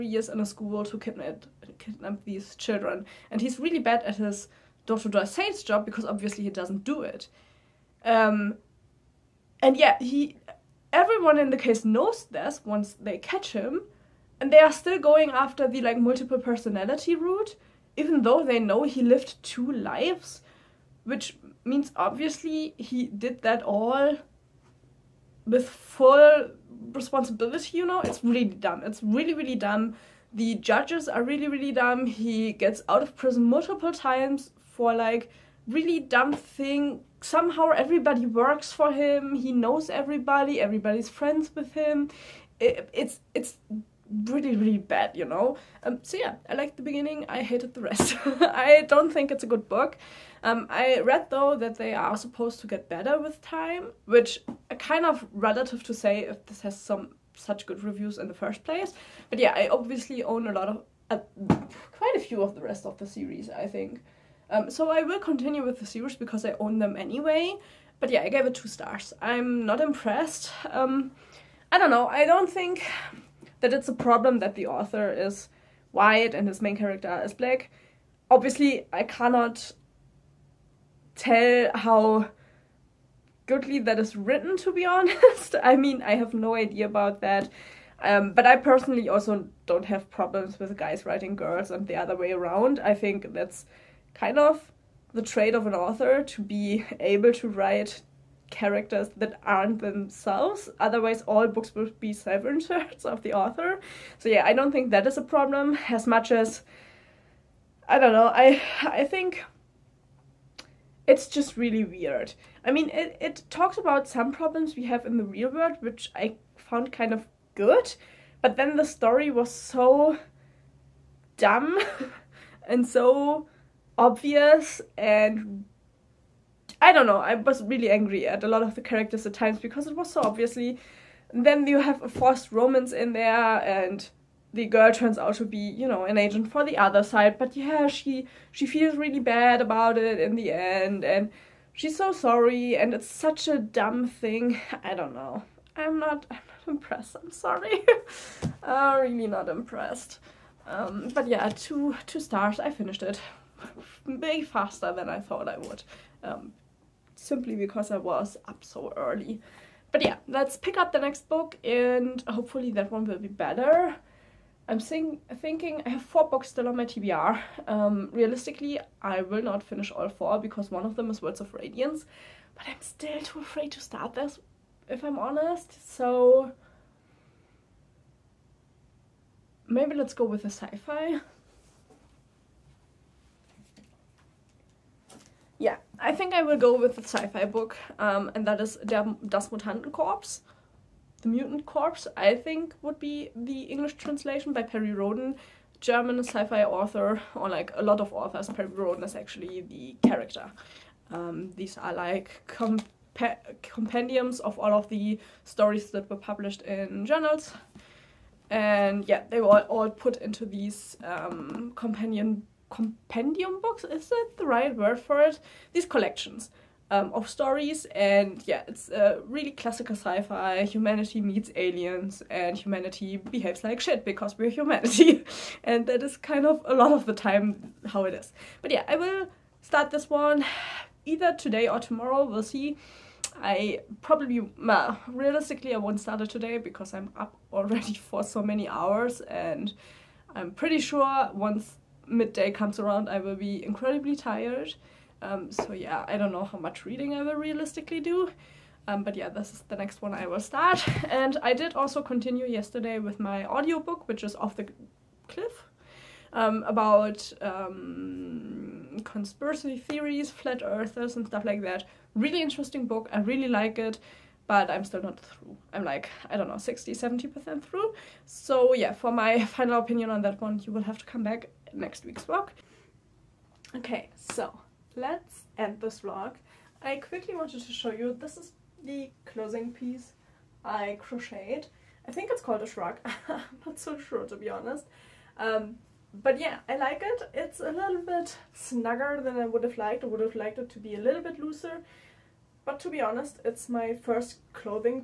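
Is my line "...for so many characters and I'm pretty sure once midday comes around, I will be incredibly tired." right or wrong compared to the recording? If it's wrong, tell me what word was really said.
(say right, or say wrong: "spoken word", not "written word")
wrong: "hours", not "characters".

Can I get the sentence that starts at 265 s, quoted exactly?
I'm like, I don't know, 60, 70% through.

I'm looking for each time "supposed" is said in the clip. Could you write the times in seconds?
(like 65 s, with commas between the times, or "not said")
52 s.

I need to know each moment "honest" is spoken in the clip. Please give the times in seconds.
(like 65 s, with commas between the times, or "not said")
84 s, 175 s, 284 s, 292 s.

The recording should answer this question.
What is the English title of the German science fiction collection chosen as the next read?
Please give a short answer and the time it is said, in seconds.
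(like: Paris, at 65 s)
The Mutant Corps, at 191 s.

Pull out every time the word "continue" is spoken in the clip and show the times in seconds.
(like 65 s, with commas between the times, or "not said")
65 s, 252 s.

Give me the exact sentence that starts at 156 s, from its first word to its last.
Um, simply because I was up so early.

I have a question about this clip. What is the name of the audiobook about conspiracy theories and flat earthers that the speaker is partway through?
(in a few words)
Off the Cliff.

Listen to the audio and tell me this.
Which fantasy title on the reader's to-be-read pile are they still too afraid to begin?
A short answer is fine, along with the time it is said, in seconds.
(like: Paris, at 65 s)
Words of Radiance, at 171 s.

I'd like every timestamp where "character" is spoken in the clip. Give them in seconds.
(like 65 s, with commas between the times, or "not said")
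76 s, 98 s, 128 s, 200 s.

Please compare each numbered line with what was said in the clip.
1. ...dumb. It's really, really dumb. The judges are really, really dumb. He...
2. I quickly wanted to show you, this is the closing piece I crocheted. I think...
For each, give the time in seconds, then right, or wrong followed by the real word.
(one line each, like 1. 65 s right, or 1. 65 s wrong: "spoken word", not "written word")
1. 28 s right
2. 276 s right.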